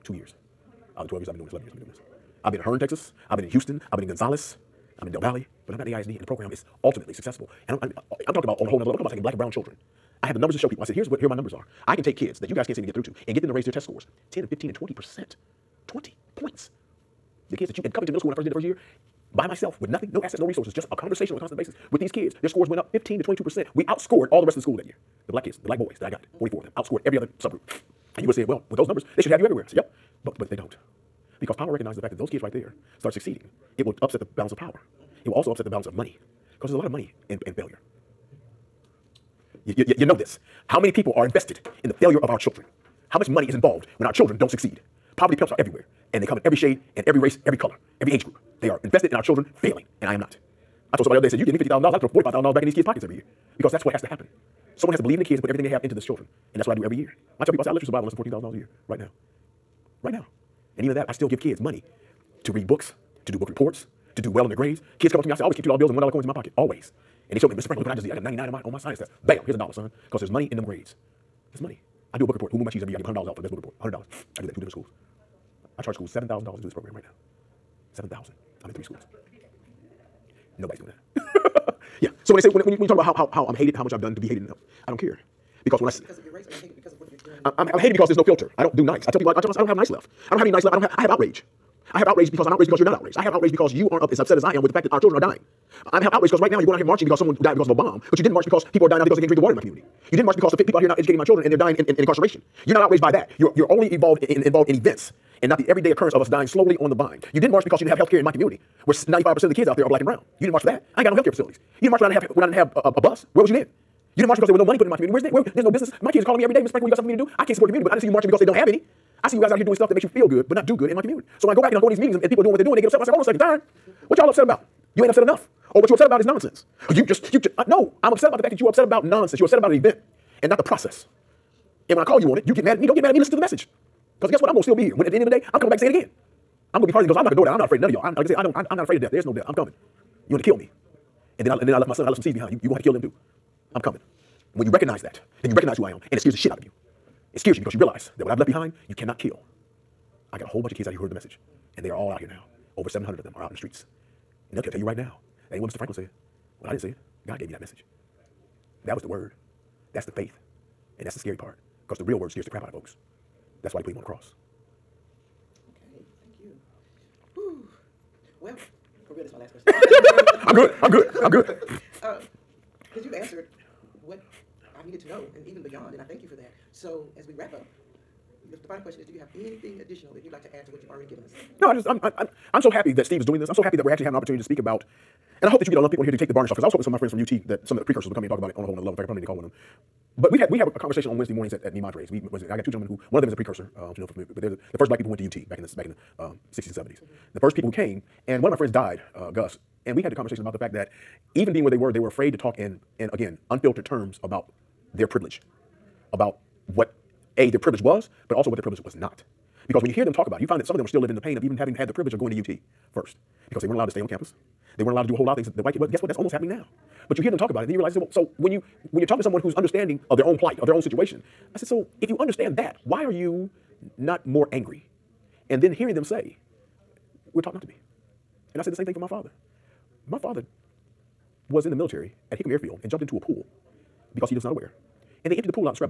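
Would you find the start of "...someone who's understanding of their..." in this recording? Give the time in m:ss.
3:39.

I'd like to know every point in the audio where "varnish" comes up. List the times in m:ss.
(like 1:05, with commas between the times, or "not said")
3:06.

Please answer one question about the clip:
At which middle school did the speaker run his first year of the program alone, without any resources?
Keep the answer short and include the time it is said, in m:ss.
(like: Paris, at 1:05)
Covington Middle School, at 0:17.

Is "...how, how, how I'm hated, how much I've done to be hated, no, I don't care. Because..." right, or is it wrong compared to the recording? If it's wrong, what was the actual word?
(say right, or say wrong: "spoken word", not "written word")
right.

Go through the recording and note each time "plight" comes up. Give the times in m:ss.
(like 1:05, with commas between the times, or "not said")
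3:40.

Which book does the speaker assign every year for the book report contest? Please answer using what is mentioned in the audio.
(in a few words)
Who Moved My Cheese.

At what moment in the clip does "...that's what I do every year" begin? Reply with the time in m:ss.
0:56.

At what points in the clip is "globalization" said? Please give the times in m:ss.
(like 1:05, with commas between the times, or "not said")
not said.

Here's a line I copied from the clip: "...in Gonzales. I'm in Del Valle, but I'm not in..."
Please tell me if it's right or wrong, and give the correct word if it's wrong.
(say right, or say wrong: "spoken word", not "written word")
right.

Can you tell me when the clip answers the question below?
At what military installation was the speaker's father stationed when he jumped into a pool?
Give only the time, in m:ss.
3:52.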